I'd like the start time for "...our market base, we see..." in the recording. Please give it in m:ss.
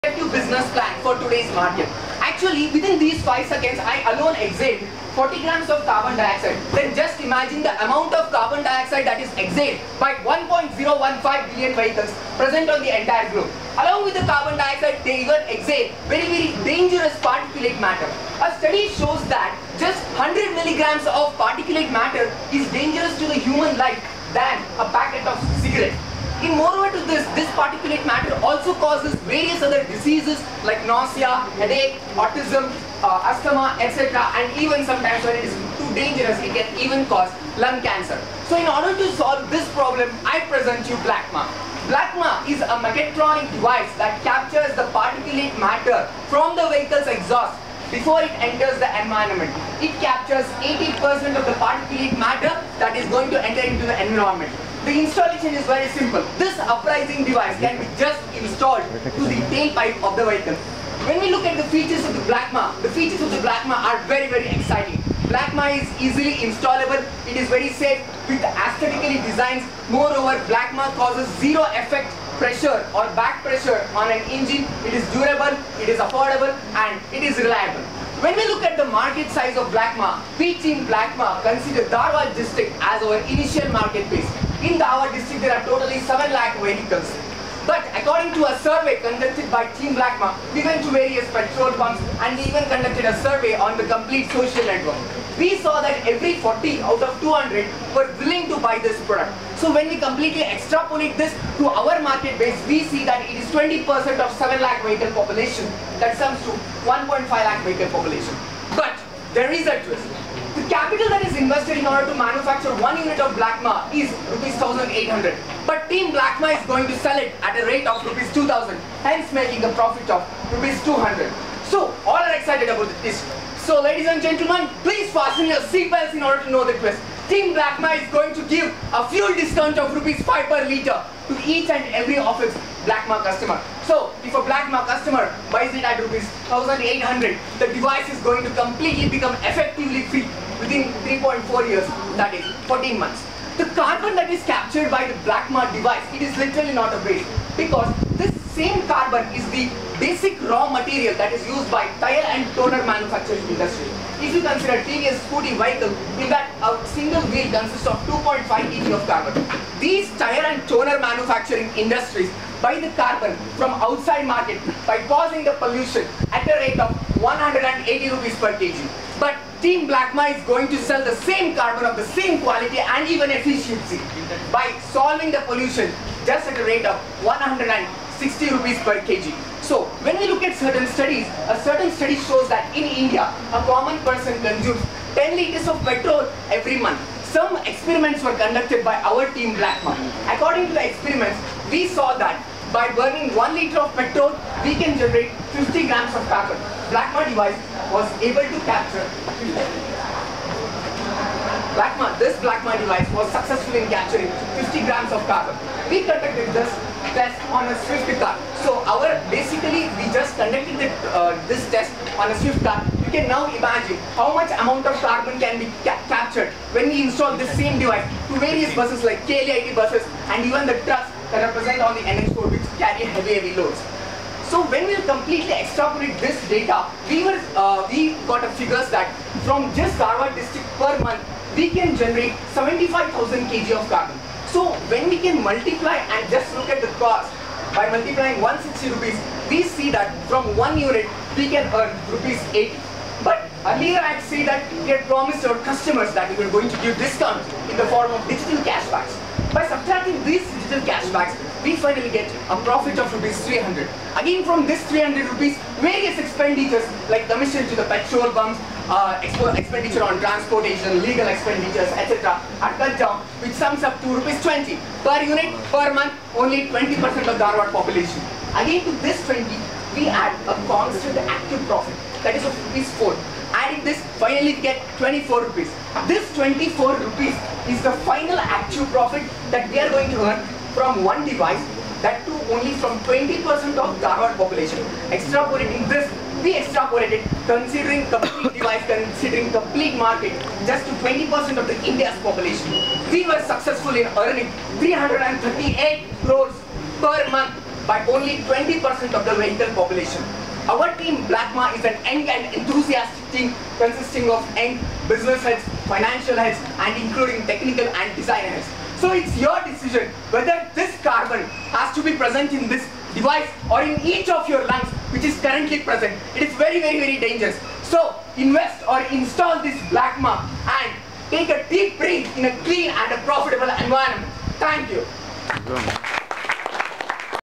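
1:41.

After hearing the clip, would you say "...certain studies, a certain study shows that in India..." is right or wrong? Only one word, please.
right.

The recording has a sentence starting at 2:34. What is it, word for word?
If you consider TVS scooty vehicle, in that a single wheel consists of 2.5 kg of carbon.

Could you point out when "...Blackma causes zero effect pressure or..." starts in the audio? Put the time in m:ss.
1:10.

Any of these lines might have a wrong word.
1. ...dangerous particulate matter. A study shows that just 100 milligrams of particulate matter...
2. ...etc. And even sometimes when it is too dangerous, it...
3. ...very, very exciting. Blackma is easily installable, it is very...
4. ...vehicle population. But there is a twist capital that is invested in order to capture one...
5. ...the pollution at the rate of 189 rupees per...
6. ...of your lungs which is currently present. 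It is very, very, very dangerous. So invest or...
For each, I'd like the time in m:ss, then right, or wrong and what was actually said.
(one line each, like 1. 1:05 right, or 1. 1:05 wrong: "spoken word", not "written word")
1. 0:16 right
2. 0:33 right
3. 1:04 right
4. 1:47 wrong: "manufacture", not "capture"
5. 2:45 wrong: "180", not "189"
6. 5:14 right.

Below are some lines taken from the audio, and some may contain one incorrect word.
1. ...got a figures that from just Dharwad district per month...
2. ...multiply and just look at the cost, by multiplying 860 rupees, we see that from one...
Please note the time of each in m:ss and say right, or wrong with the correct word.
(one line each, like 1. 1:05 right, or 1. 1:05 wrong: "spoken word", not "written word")
1. 3:48 right
2. 3:55 wrong: "160", not "860".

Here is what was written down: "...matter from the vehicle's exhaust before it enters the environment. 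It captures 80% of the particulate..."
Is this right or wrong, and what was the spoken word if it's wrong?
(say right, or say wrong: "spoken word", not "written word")
right.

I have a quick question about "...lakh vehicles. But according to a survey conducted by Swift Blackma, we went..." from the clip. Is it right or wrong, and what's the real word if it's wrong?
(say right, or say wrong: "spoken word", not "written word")
wrong: "Team", not "Swift".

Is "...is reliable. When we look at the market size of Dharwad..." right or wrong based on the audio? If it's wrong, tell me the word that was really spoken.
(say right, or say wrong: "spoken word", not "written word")
wrong: "Blackma", not "Dharwad".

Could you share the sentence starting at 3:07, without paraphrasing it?
Some experiments were conducted by our team Blackma.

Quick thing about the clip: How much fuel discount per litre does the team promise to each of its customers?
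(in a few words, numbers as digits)
Rupees 5.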